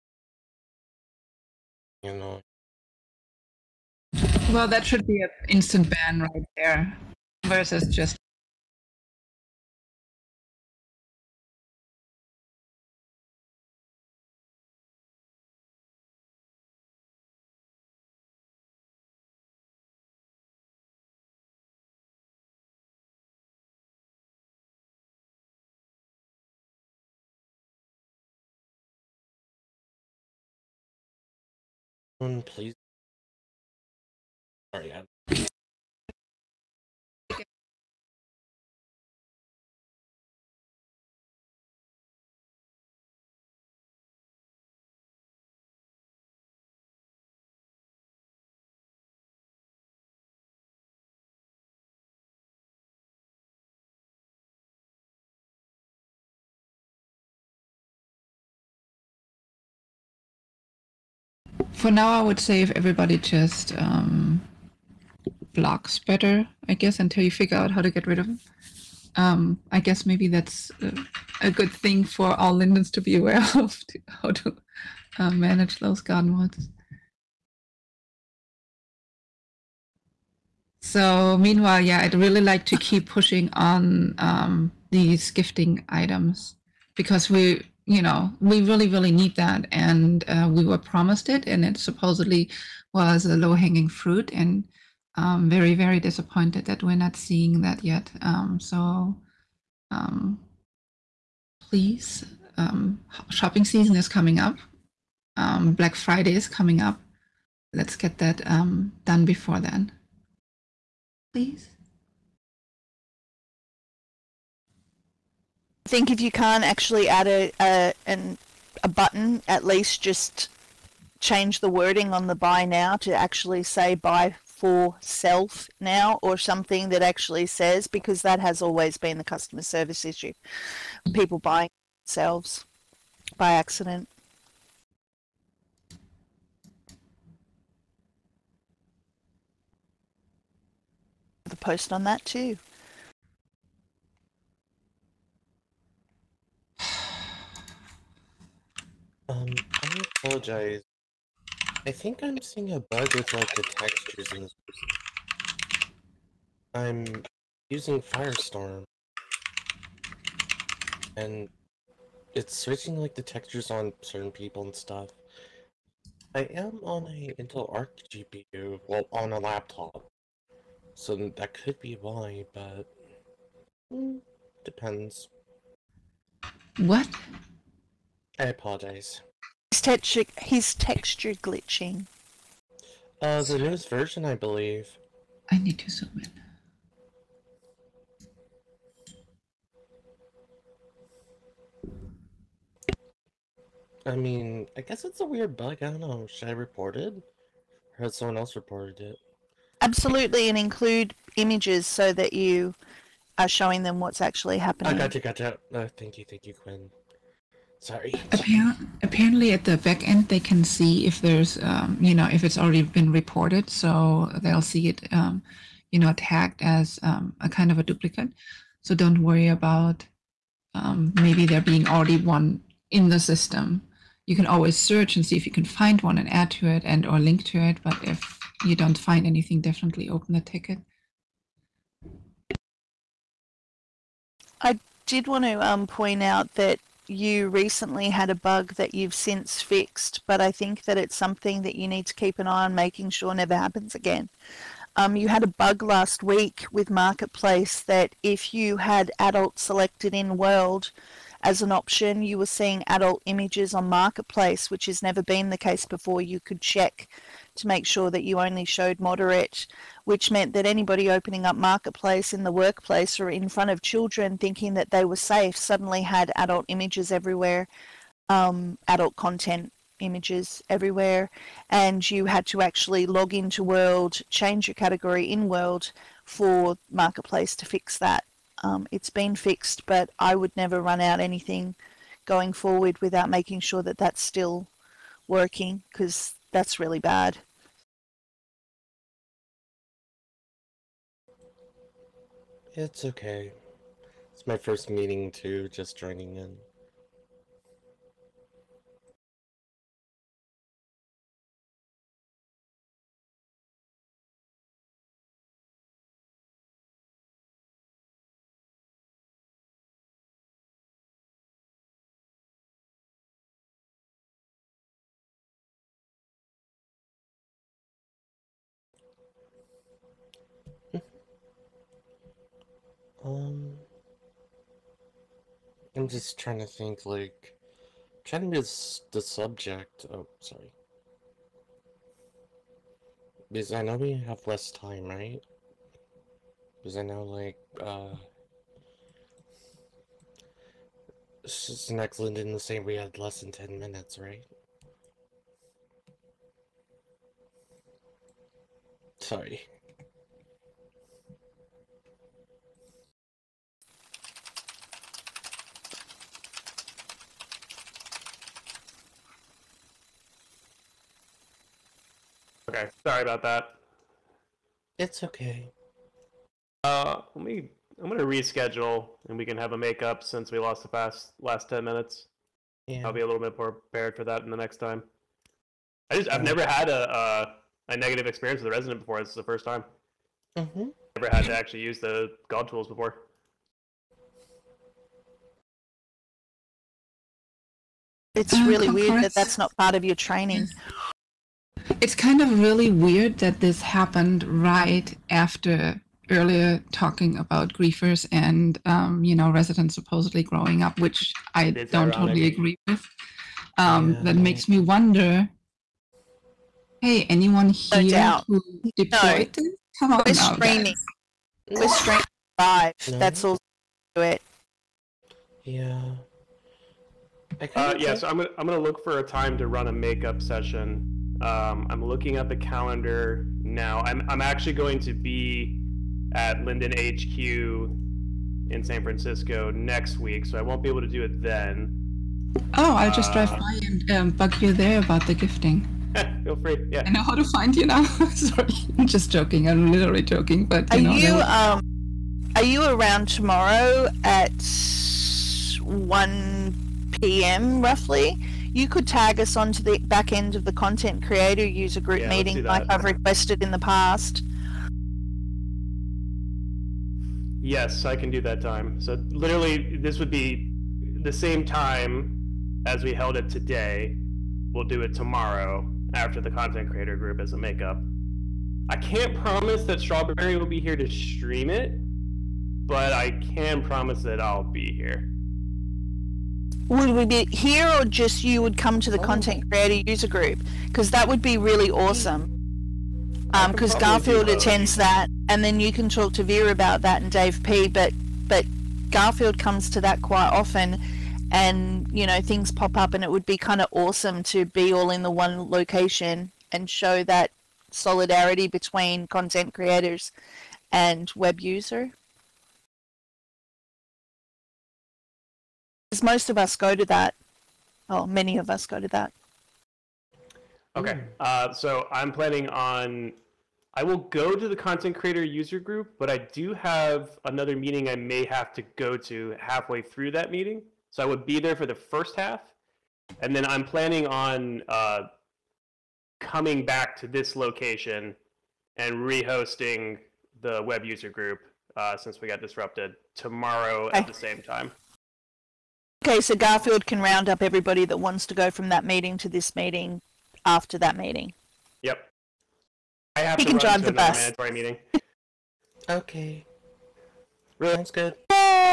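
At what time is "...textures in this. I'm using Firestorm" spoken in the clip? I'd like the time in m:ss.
2:33.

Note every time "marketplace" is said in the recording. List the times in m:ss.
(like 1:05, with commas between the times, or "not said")
4:06, 4:13, 4:21, 4:36.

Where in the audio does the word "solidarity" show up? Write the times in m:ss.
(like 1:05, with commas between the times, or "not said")
8:17.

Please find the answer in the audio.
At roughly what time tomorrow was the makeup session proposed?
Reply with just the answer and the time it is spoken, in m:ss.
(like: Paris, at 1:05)
1 p.m., at 7:25.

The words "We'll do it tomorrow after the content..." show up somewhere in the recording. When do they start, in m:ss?
7:44.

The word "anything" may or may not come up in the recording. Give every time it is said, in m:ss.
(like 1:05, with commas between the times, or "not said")
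3:49, 4:41.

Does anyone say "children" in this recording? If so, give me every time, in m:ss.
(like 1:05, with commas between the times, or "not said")
4:23.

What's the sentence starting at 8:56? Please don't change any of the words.
Okay, so Garfield can round up everybody that wants to go from that meeting to this meeting after that meeting.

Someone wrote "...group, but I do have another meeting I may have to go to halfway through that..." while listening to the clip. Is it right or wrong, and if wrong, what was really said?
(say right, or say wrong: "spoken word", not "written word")
right.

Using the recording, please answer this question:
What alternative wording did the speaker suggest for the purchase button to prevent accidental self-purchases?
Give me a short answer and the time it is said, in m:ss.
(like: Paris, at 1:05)
buy for self now, at 2:03.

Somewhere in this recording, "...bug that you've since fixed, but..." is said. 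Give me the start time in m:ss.
3:58.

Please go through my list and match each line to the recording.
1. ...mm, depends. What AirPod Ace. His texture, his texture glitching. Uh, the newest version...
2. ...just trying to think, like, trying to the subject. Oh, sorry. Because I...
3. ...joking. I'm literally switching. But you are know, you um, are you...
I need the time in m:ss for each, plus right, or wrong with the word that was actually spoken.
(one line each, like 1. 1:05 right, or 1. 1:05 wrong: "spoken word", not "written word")
1. 2:53 right
2. 5:26 right
3. 7:19 wrong: "joking", not "switching".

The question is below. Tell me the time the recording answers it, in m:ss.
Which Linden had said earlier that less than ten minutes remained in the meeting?
5:41.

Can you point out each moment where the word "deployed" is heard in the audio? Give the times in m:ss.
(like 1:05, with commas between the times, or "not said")
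6:48.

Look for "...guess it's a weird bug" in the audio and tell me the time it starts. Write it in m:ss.
3:14.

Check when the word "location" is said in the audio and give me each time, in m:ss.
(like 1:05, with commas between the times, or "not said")
8:15, 8:47.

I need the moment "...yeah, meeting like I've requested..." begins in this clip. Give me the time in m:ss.
7:32.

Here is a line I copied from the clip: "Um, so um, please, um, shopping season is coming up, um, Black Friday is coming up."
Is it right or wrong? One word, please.
right.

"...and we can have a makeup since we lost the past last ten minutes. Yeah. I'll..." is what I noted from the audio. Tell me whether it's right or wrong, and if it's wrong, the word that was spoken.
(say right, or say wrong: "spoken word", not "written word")
right.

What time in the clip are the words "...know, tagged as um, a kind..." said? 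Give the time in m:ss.
3:35.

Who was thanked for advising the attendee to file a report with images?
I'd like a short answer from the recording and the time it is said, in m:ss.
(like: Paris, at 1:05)
Quinn, at 3:26.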